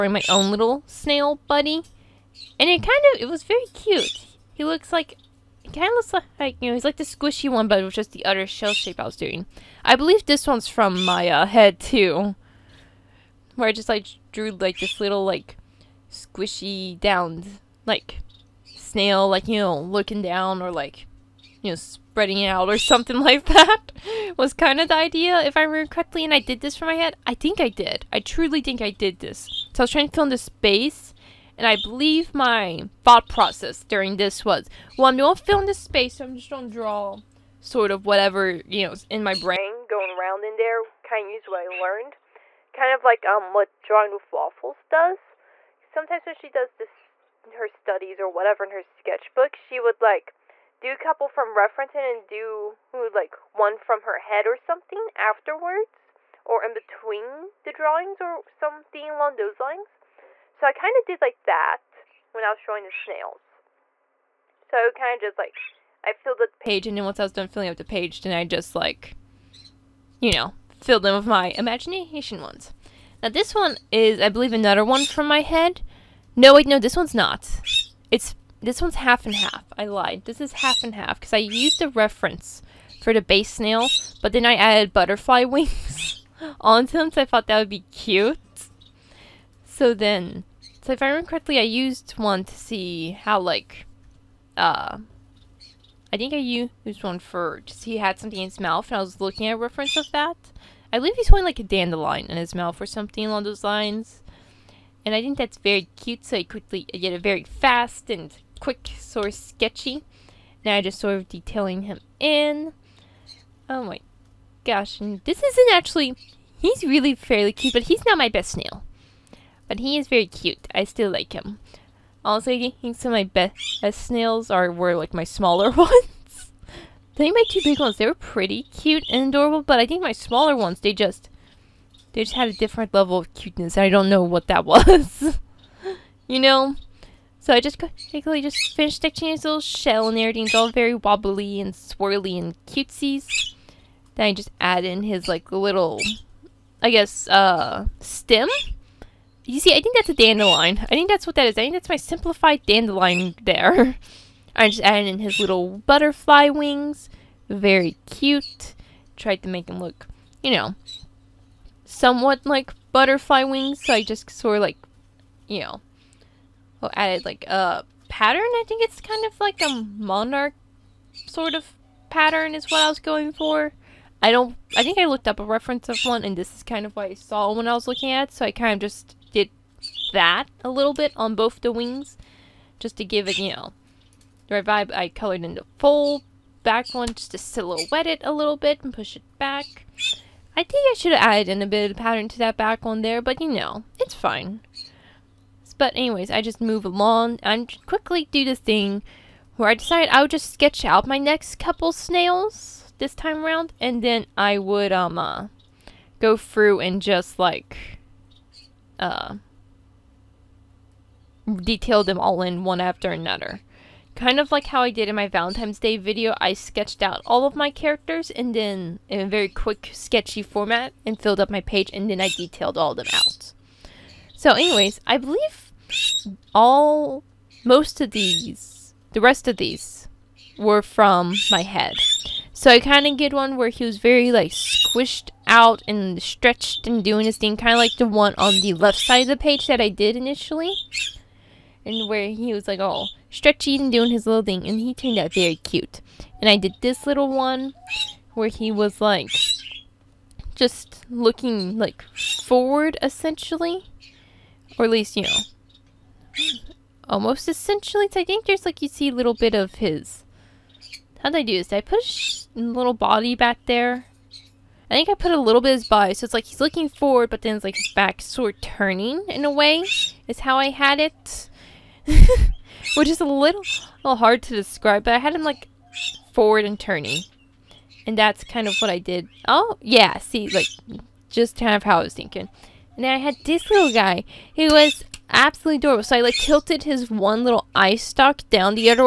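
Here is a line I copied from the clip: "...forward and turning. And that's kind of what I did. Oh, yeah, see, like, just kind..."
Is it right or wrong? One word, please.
right.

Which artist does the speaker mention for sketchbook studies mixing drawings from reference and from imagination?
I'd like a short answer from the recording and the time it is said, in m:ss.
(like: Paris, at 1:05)
Drawing Wiff Waffles, at 0:43.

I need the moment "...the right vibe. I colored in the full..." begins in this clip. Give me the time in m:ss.
3:04.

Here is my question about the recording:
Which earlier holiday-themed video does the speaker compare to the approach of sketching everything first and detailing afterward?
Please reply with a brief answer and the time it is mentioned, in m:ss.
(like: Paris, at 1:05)
Valentine's Day video, at 3:35.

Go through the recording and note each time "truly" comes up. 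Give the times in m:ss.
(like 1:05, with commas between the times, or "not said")
0:28.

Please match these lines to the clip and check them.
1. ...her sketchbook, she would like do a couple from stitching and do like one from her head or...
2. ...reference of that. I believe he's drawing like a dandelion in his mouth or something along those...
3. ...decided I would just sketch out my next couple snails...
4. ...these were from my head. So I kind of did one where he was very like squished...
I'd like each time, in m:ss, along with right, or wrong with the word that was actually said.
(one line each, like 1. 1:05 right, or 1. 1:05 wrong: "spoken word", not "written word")
1. 0:48 wrong: "referencing", not "stitching"
2. 1:39 wrong: "holding", not "drawing"
3. 3:19 right
4. 3:49 right.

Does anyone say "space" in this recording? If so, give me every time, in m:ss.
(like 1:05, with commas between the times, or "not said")
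0:30, 0:35.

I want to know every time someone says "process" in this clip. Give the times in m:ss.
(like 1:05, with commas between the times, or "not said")
0:33.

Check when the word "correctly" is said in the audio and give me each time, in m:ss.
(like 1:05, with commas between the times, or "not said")
0:25, 1:31.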